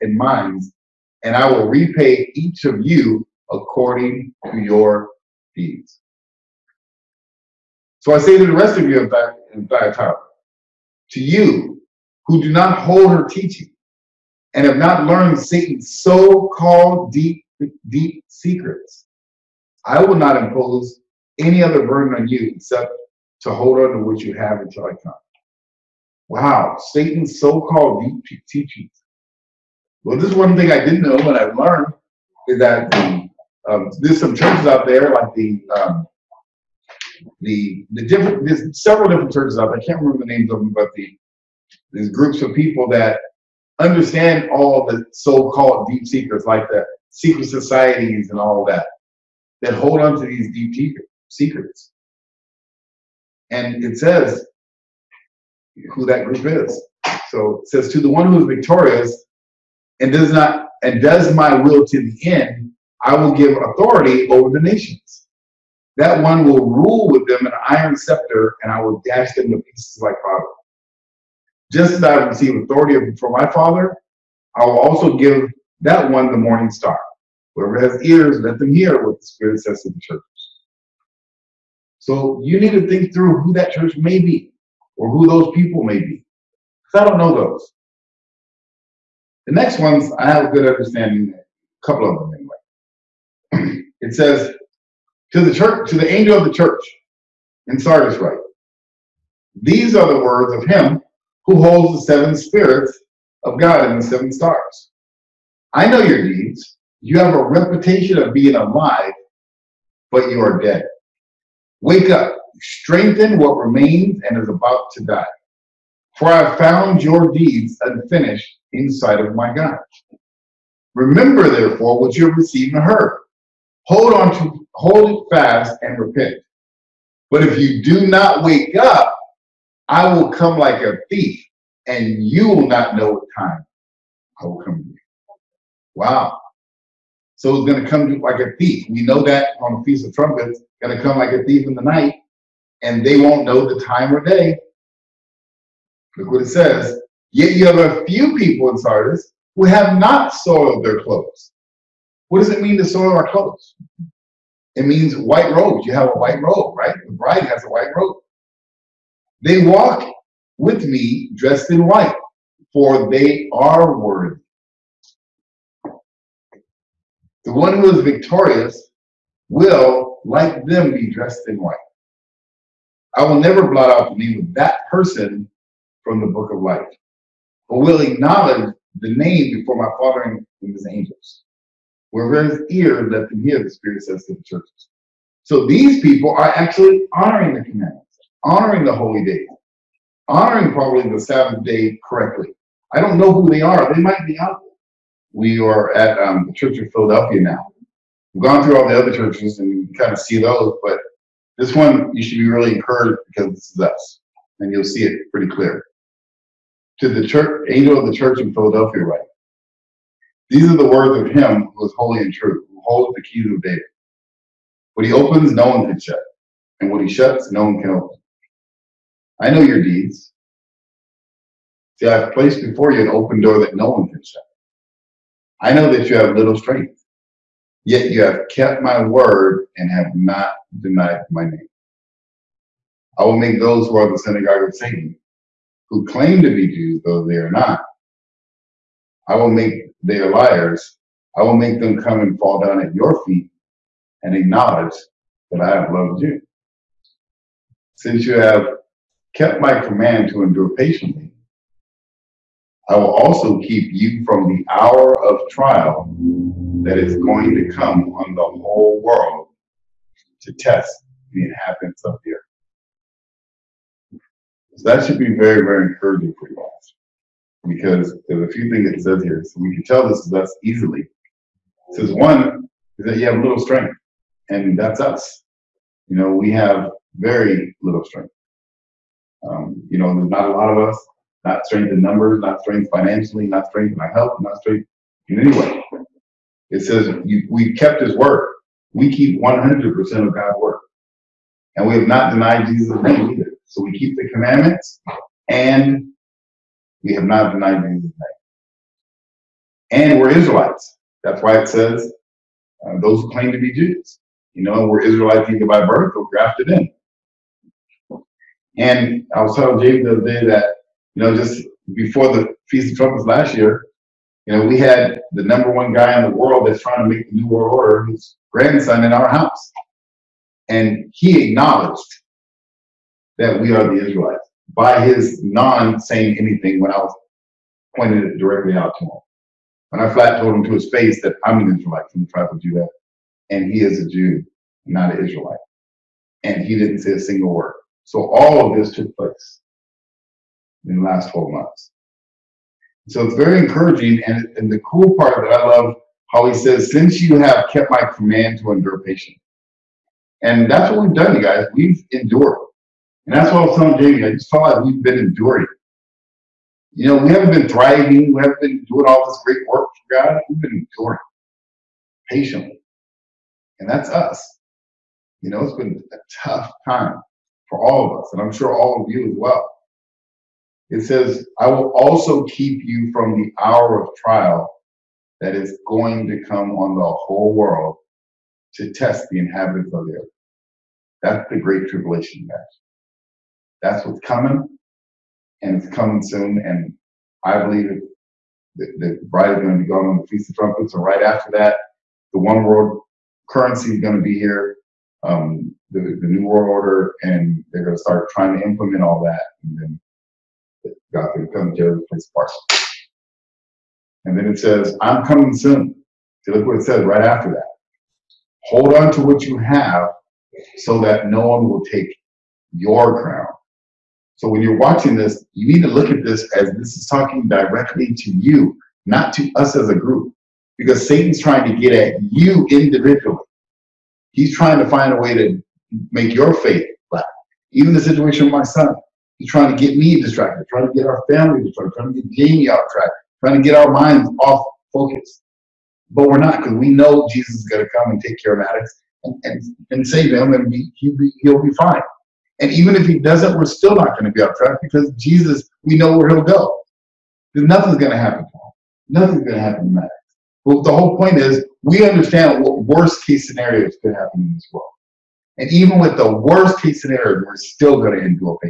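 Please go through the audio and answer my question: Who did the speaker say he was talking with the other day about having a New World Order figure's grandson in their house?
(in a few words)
James.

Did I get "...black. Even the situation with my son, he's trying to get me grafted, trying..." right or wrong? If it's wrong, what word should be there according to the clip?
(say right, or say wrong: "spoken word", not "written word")
wrong: "distracted", not "grafted".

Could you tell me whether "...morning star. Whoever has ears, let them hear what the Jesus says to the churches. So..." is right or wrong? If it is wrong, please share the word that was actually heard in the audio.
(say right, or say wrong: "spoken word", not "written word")
wrong: "Spirit", not "Jesus".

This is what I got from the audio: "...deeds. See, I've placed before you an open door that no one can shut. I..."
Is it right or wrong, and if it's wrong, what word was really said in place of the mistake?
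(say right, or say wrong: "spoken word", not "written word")
right.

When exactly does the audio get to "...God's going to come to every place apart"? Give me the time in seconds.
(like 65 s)
401 s.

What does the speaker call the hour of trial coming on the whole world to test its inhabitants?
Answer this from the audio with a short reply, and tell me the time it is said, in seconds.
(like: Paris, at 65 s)
The great tribulation, at 381 s.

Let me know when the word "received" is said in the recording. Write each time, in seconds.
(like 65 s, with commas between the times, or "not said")
72 s, 122 s.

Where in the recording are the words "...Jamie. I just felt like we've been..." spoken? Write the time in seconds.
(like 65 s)
353 s.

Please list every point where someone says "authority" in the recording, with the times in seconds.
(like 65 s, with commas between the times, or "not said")
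63 s, 72 s.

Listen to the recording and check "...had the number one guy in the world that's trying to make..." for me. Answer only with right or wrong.
right.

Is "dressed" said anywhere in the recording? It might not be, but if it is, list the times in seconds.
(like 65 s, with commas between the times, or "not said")
161 s, 171 s.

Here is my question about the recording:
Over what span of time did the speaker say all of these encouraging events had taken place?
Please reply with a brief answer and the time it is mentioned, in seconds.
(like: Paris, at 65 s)
12 months, at 341 s.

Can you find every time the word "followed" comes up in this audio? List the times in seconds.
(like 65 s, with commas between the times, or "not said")
not said.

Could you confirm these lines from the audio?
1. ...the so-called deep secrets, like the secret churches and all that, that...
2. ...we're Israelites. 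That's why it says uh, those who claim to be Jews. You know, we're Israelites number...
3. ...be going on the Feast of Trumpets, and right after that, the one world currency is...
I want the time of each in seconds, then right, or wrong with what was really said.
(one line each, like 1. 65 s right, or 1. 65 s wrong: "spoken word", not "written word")
1. 44 s wrong: "societies", not "churches"
2. 300 s wrong: "either", not "number"
3. 389 s right.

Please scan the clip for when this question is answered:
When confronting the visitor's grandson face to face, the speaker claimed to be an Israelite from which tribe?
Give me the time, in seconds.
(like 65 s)
332 s.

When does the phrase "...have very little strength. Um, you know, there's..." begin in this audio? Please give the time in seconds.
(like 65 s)
276 s.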